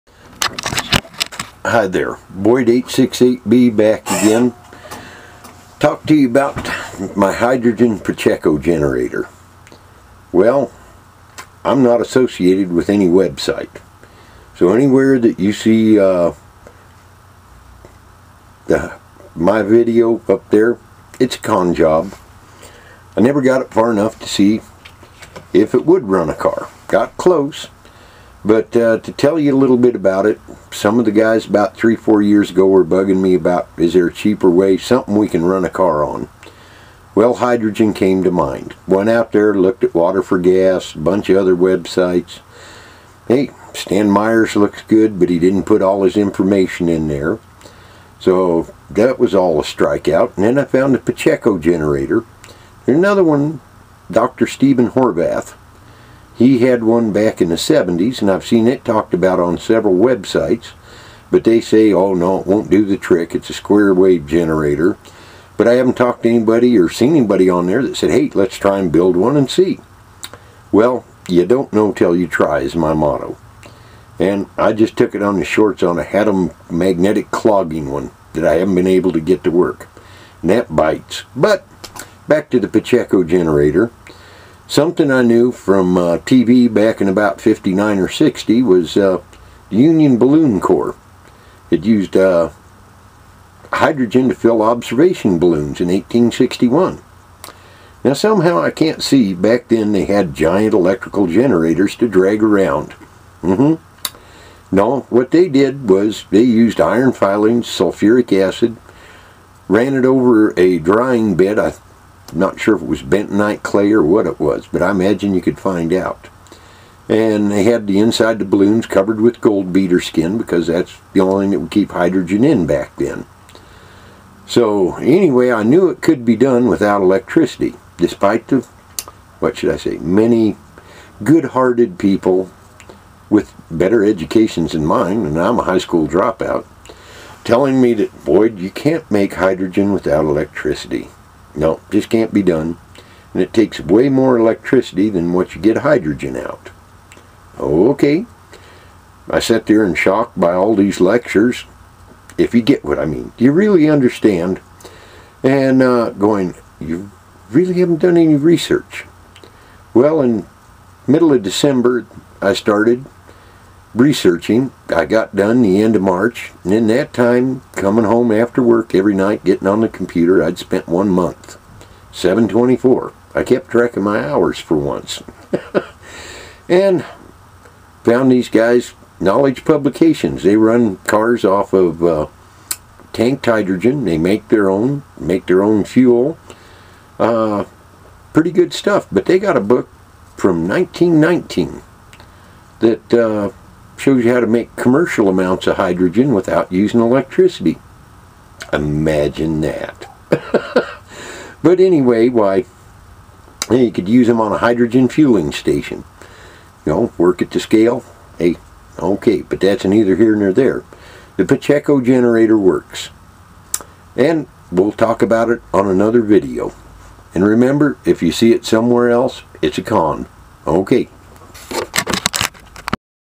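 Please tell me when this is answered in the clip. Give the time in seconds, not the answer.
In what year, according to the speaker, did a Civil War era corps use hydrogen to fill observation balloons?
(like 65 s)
95 s.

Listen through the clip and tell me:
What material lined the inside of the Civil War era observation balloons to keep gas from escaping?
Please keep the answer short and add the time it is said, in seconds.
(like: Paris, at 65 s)
gold beater skin, at 119 s.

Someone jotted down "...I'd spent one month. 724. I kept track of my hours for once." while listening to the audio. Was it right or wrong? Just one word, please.
right.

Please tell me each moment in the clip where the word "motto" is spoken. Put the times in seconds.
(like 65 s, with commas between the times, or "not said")
72 s.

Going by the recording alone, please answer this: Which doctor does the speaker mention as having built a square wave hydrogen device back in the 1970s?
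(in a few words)
Dr. Stephen Horvath.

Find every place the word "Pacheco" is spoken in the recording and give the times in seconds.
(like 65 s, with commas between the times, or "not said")
7 s, 50 s, 82 s, 211 s.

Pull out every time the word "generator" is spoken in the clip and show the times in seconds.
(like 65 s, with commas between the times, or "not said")
8 s, 51 s, 64 s, 83 s, 101 s, 212 s.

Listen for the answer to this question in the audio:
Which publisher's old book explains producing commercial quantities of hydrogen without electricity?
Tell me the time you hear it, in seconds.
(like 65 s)
179 s.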